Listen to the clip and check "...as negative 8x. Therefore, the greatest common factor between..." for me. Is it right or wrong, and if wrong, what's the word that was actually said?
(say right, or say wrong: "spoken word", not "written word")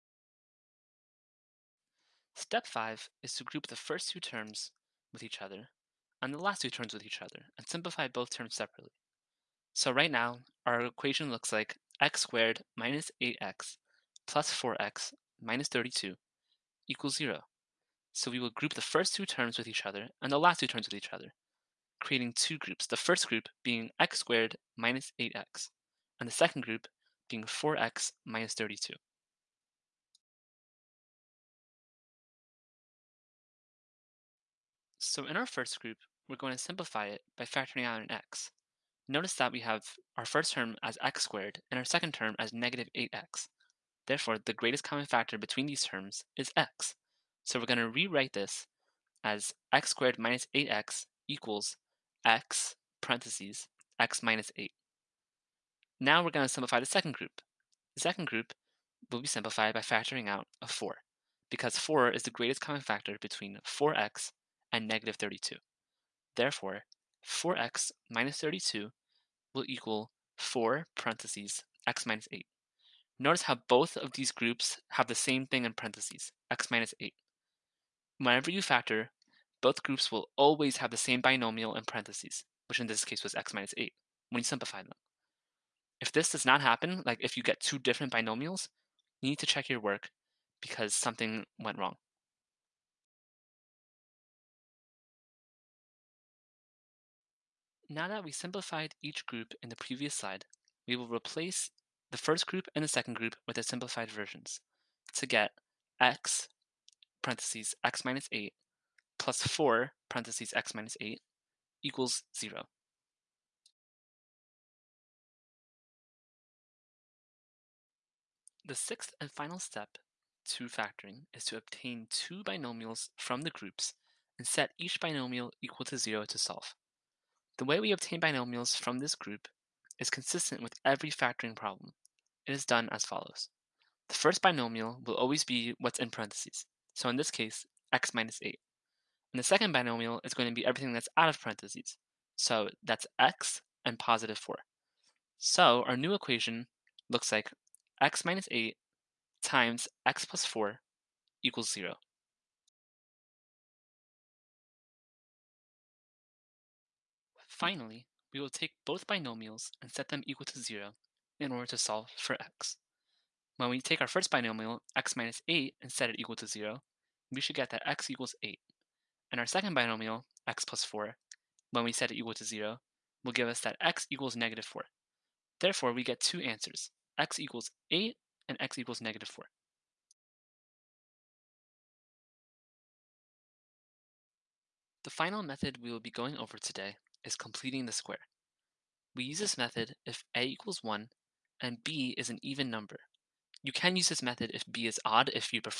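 right.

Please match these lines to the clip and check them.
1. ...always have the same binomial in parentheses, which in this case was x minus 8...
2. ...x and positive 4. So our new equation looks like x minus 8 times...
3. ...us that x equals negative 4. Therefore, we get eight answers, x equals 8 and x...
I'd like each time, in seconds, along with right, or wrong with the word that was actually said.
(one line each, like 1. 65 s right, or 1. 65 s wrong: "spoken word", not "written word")
1. 80 s right
2. 143 s right
3. 173 s wrong: "two", not "eight".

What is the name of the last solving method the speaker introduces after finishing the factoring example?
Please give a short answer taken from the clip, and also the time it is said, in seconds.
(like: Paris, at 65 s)
completing the square, at 187 s.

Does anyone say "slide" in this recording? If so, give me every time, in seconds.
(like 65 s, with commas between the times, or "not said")
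100 s.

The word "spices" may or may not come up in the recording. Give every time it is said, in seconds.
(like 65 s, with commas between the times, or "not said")
not said.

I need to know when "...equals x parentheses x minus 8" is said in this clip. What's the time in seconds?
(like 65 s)
51 s.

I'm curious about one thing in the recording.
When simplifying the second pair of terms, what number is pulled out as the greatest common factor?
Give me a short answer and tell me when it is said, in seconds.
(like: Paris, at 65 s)
4, at 59 s.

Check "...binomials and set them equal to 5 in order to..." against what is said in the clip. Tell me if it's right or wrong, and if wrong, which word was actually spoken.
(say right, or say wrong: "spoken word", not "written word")
wrong: "0", not "5".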